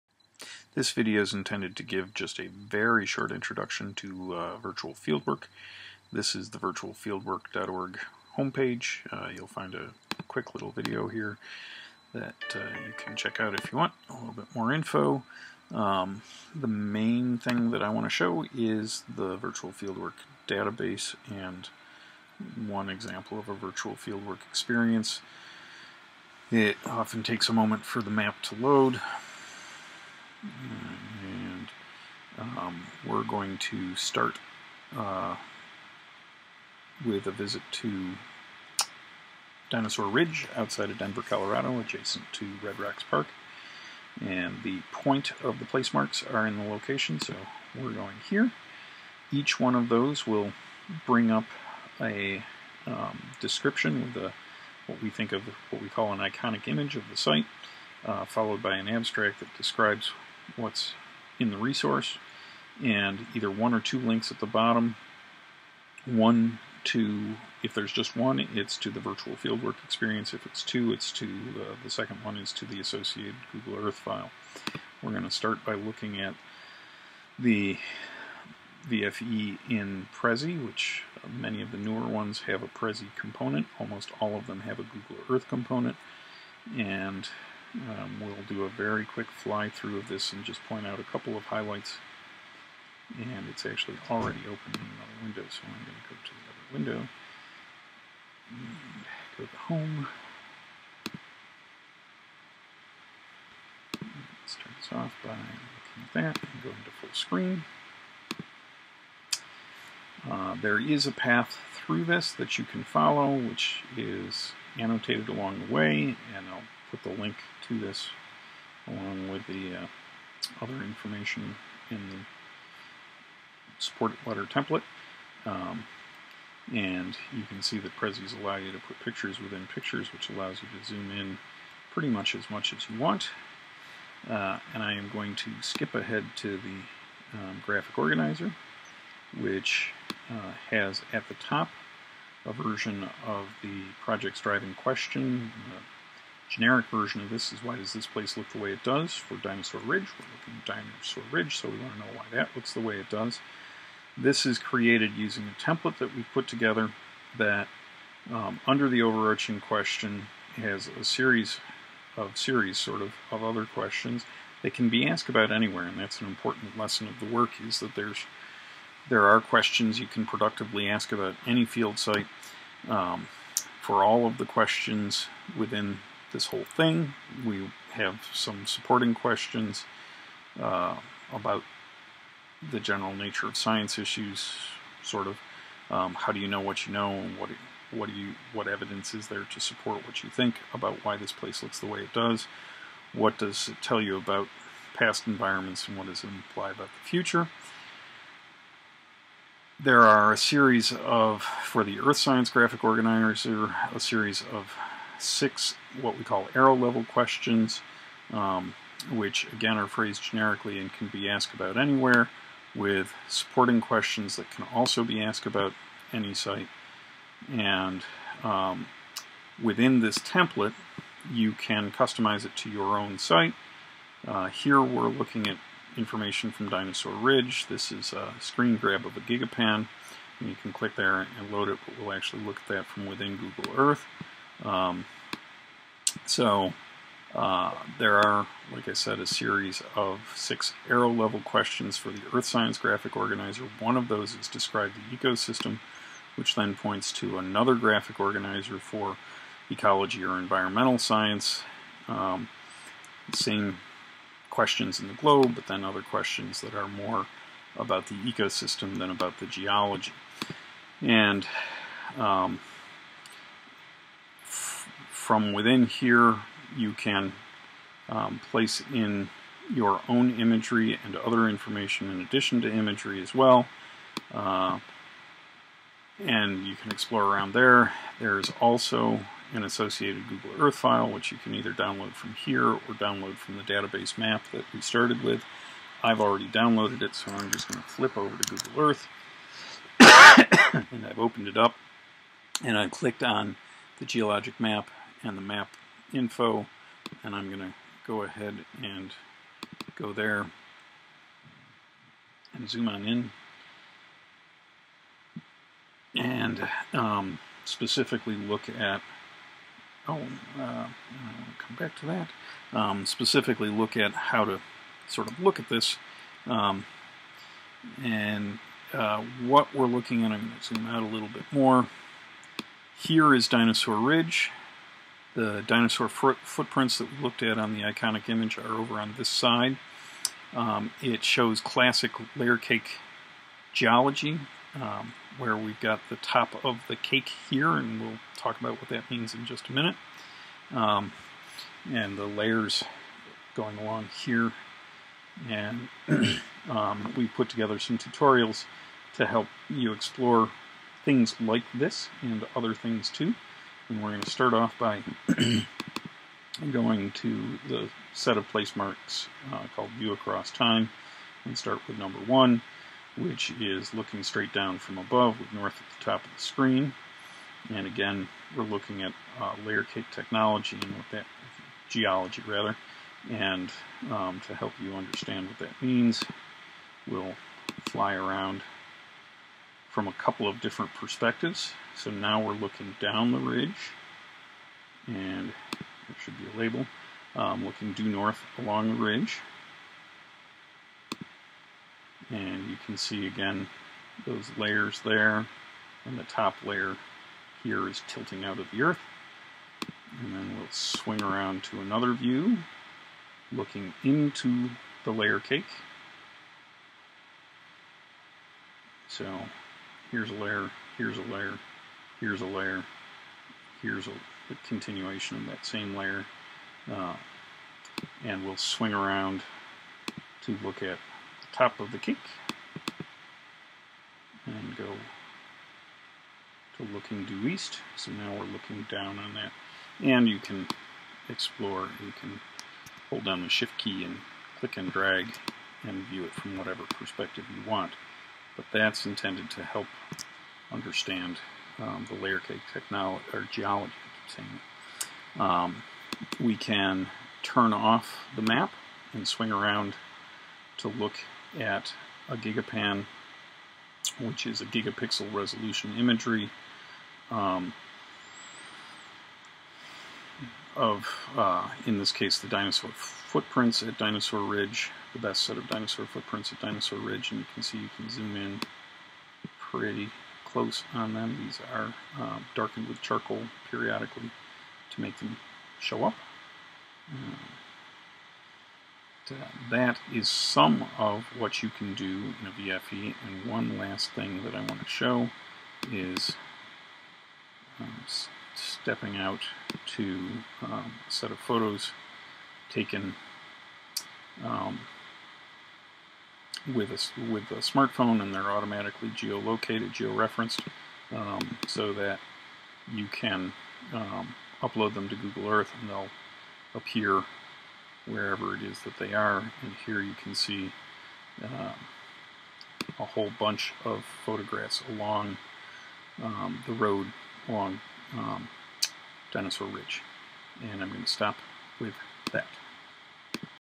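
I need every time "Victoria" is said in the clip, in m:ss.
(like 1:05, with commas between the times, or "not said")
not said.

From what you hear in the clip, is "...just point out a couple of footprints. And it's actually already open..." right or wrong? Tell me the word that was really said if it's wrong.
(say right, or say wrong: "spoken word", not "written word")
wrong: "highlights", not "footprints".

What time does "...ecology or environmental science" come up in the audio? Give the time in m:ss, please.
4:09.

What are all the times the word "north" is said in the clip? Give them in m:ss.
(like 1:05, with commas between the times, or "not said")
6:05, 6:28.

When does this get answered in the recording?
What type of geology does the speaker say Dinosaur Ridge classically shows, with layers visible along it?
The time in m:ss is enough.
5:32.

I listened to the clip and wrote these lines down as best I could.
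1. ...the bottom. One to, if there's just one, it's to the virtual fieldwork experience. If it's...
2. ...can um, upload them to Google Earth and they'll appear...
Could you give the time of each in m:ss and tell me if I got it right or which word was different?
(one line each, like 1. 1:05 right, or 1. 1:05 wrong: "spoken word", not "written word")
1. 1:04 right
2. 8:23 right.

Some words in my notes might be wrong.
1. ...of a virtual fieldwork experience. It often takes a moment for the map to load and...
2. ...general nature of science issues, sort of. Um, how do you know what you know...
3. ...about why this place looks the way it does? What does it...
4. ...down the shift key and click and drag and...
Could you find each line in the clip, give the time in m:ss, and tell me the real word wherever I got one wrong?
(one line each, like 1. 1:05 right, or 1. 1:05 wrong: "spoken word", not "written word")
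1. 0:23 right
2. 3:02 right
3. 3:10 right
4. 7:13 right.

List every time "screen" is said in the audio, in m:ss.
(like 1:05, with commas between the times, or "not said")
1:47, 3:48, 6:06.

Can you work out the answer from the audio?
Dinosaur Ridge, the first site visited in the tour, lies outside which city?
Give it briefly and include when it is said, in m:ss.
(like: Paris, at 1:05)
Denver, at 0:40.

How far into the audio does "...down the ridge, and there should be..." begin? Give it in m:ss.
6:23.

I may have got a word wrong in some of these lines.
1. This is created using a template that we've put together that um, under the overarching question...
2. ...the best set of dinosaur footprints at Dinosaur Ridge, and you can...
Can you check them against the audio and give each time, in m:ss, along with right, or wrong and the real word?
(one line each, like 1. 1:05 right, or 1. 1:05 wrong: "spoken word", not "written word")
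1. 2:34 right
2. 7:45 right.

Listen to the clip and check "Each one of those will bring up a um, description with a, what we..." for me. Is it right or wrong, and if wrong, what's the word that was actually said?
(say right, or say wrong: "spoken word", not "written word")
right.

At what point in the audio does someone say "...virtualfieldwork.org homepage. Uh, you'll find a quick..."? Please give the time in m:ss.
0:06.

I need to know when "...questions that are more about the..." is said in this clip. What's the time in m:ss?
4:16.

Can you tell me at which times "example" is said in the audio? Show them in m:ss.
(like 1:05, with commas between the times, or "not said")
0:22.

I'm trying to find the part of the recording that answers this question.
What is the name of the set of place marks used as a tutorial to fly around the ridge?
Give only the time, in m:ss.
5:59.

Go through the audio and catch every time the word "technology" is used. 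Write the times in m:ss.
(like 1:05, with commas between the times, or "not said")
6:10, 7:22.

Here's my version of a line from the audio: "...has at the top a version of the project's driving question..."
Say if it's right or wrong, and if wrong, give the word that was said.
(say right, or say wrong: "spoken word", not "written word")
right.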